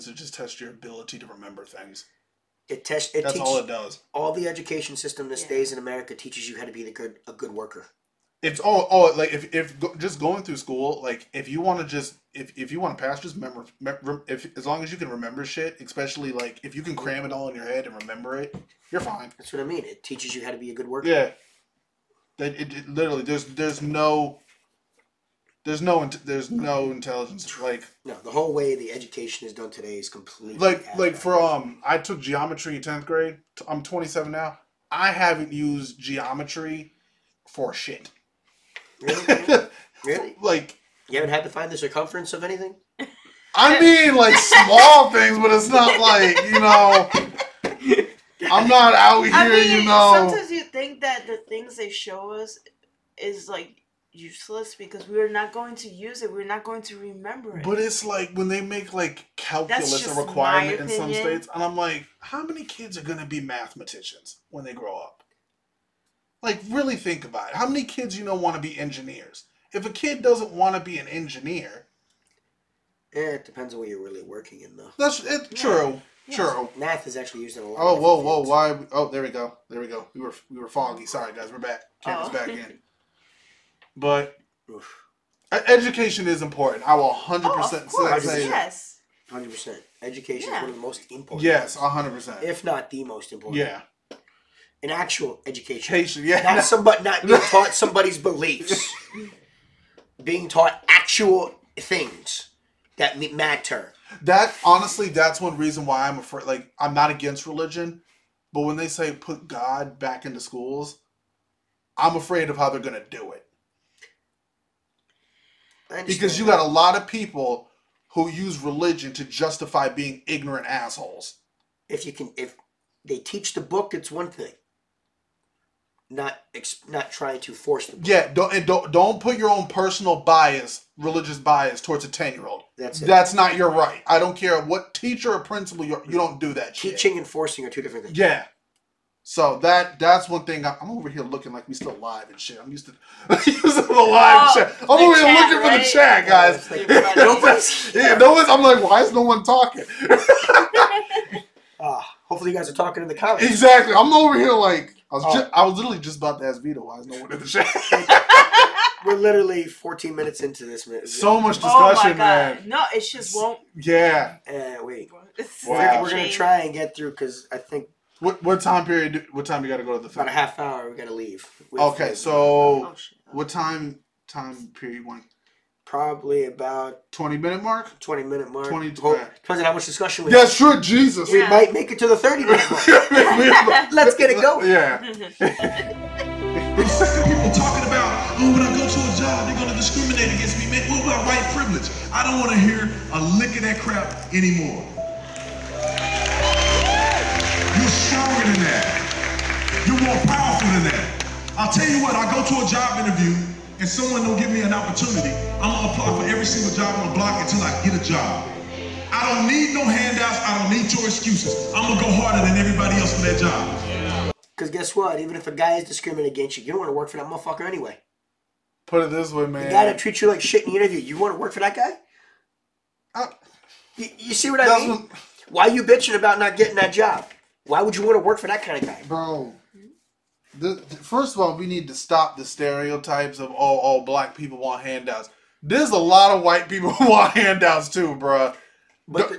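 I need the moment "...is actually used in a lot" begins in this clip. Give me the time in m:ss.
1:17.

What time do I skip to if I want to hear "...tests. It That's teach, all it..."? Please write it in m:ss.
0:02.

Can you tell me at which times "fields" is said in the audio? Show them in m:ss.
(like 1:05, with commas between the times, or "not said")
1:18.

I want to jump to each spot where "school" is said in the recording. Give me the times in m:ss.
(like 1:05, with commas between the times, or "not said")
0:10, 1:50.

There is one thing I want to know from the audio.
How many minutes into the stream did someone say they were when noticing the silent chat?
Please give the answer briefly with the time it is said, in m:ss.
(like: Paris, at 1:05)
14, at 2:39.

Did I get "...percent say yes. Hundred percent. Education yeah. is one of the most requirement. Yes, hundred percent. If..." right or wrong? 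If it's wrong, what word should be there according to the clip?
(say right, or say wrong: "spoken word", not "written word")
wrong: "important", not "requirement".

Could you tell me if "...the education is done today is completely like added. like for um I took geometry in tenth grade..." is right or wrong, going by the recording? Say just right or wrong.
right.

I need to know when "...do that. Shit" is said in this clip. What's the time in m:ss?
2:16.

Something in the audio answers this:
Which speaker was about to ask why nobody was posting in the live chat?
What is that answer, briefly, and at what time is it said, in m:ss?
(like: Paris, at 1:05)
Vito, at 2:36.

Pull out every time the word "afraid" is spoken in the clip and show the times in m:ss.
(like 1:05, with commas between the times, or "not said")
1:46, 1:52.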